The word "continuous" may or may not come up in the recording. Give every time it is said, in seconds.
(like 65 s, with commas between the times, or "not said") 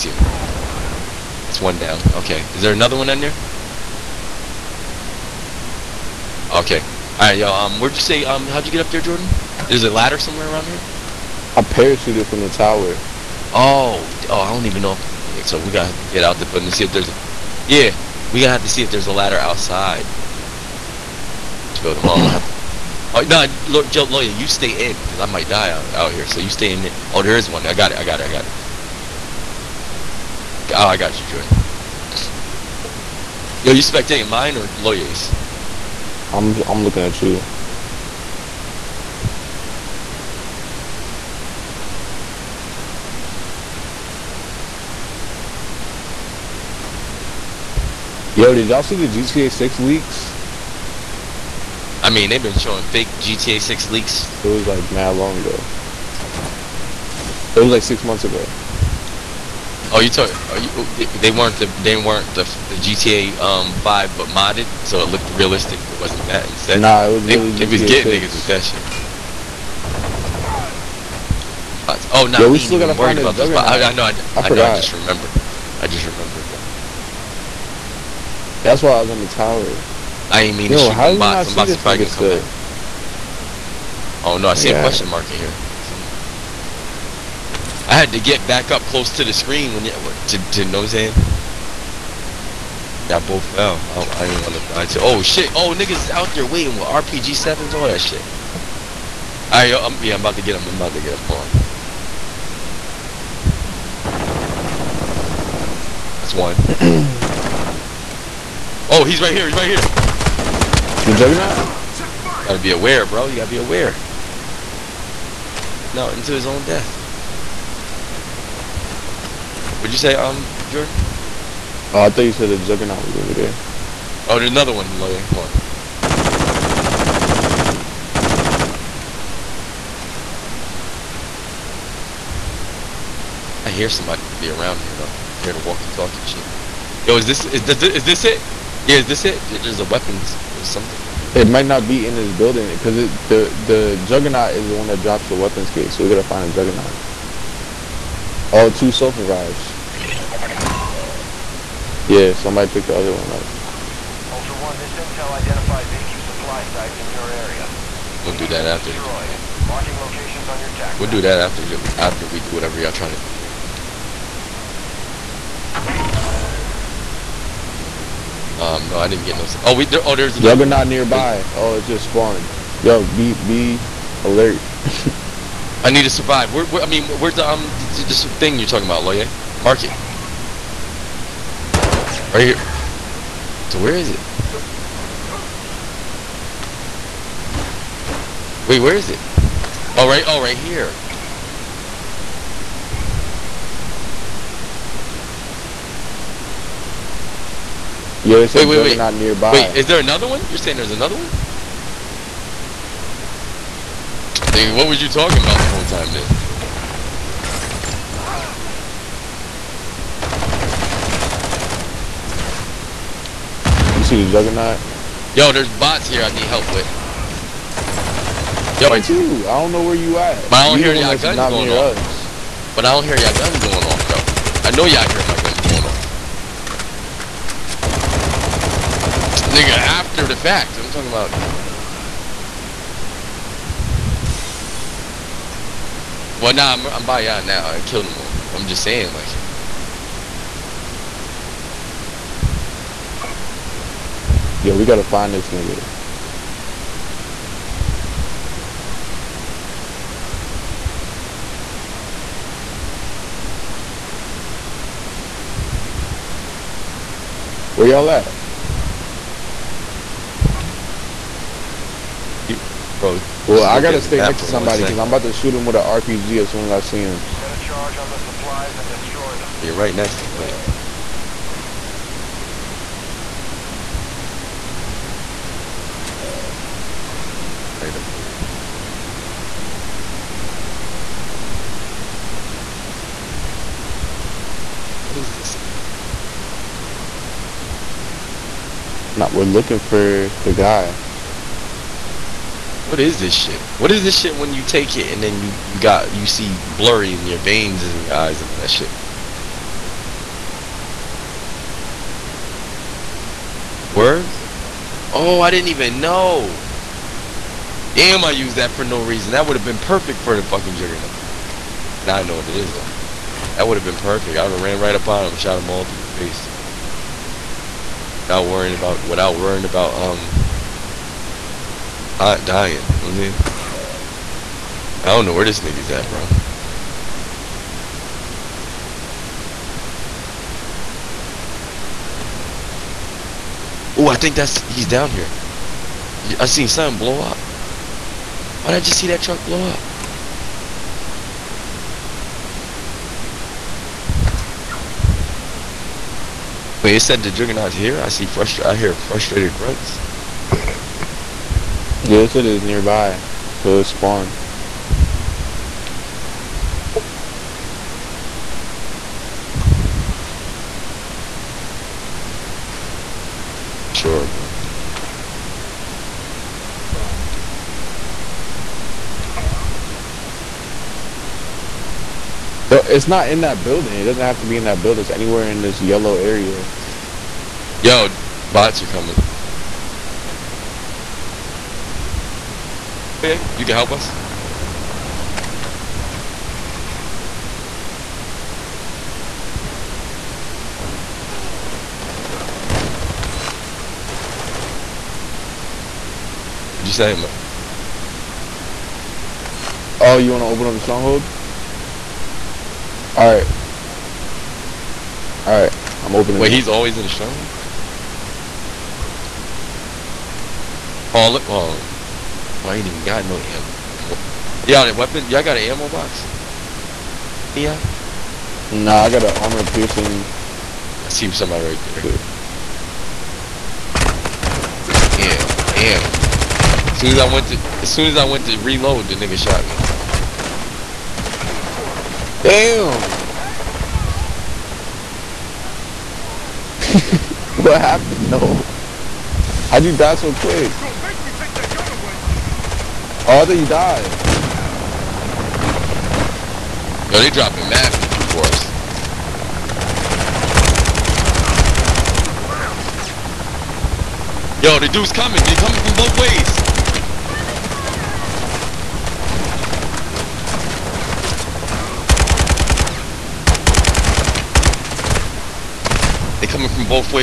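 not said.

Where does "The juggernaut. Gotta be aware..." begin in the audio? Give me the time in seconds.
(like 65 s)
111 s.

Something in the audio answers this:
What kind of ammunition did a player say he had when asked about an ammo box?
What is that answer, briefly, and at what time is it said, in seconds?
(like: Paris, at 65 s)
Armor piercing, at 419 s.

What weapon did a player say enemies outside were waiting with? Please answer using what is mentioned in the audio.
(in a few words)
RPG sevens.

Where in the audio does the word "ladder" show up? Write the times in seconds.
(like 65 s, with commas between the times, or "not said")
9 s, 19 s.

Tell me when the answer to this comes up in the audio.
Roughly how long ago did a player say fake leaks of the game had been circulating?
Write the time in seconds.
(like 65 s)
57 s.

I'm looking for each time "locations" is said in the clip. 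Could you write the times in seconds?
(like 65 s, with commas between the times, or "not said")
159 s.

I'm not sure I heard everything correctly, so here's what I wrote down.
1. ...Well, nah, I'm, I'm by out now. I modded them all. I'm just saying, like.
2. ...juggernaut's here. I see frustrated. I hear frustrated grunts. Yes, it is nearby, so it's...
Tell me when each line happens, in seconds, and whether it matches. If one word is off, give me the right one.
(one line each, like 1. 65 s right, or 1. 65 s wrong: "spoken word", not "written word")
1. 236 s wrong: "killed", not "modded"
2. 347 s right.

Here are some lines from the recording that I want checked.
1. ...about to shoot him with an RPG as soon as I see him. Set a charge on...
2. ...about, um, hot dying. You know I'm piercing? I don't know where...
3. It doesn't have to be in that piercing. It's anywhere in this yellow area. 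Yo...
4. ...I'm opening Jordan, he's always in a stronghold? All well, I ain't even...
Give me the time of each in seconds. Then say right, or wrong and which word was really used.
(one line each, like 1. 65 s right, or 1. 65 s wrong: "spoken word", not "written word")
1. 265 s right
2. 319 s wrong: "saying", not "piercing"
3. 373 s wrong: "building", not "piercing"
4. 406 s wrong: "Wait", not "Jordan".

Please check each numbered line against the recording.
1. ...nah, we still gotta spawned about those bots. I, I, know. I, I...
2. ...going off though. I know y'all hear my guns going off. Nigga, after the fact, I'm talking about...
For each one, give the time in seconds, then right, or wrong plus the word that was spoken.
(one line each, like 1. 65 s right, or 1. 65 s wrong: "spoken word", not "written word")
1. 72 s wrong: "worried", not "spawned"
2. 223 s right.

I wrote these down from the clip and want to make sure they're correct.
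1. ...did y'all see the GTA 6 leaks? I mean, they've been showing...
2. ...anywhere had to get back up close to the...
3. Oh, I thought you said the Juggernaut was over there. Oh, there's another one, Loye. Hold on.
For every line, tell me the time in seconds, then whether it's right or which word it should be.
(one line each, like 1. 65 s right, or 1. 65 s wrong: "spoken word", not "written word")
1. 48 s right
2. 85 s wrong: "somewhere", not "anywhere"
3. 121 s right.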